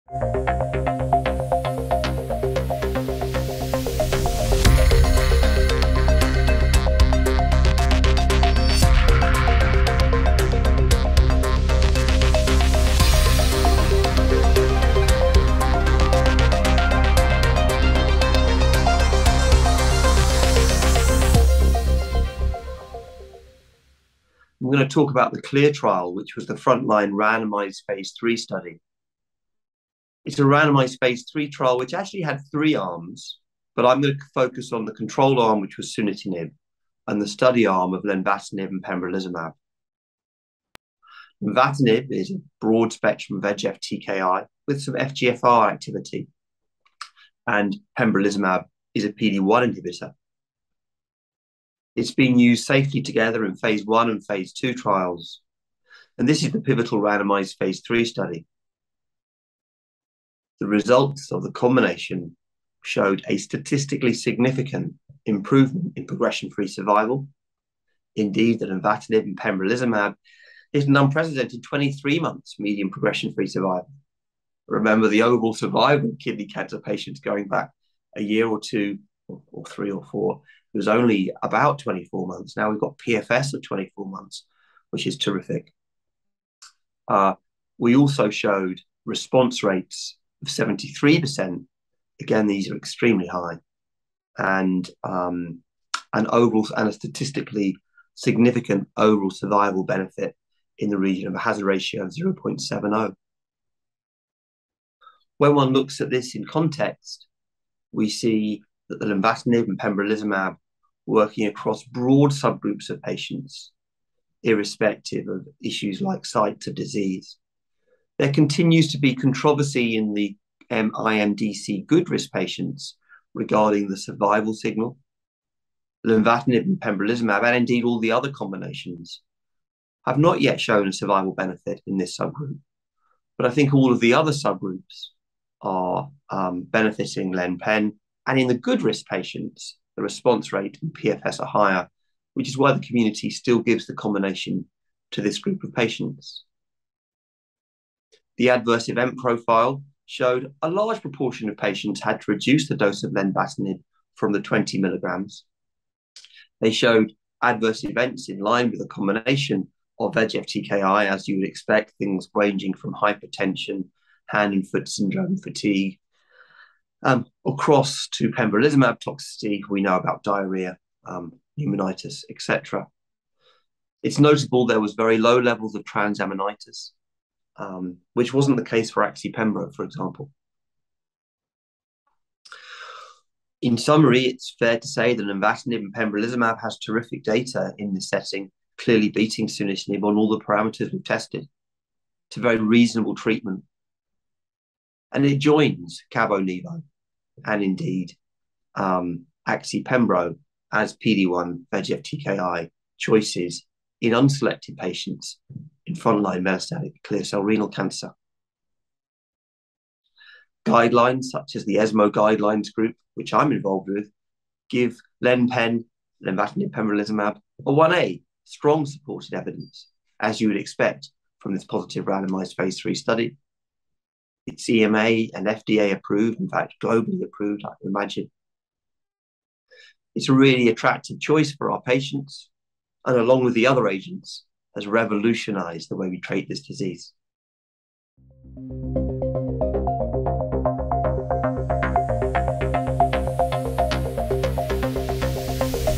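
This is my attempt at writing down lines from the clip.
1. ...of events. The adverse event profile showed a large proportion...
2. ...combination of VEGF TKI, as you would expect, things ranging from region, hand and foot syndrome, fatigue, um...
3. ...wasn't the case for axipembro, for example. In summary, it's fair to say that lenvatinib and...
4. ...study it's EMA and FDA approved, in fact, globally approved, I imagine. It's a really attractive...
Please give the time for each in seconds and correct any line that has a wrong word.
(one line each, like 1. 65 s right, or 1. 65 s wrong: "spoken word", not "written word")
1. 145 s wrong: "patients", not "events"
2. 158 s wrong: "hypertension", not "region"
3. 178 s right
4. 222 s right.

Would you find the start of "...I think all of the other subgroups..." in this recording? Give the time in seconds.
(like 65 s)
133 s.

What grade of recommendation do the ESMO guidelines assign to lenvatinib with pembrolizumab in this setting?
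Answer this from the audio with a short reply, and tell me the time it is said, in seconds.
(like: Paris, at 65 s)
1A, at 217 s.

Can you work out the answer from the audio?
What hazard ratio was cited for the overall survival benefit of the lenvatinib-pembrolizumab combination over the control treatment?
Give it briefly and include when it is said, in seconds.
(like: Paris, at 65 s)
0.70, at 102 s.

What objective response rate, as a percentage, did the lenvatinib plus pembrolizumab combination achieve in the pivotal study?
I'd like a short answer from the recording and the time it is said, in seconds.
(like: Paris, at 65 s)
73%, at 90 s.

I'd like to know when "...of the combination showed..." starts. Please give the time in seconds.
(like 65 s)
61 s.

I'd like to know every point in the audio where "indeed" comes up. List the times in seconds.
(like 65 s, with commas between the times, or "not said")
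68 s, 127 s, 197 s.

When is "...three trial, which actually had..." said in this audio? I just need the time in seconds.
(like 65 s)
31 s.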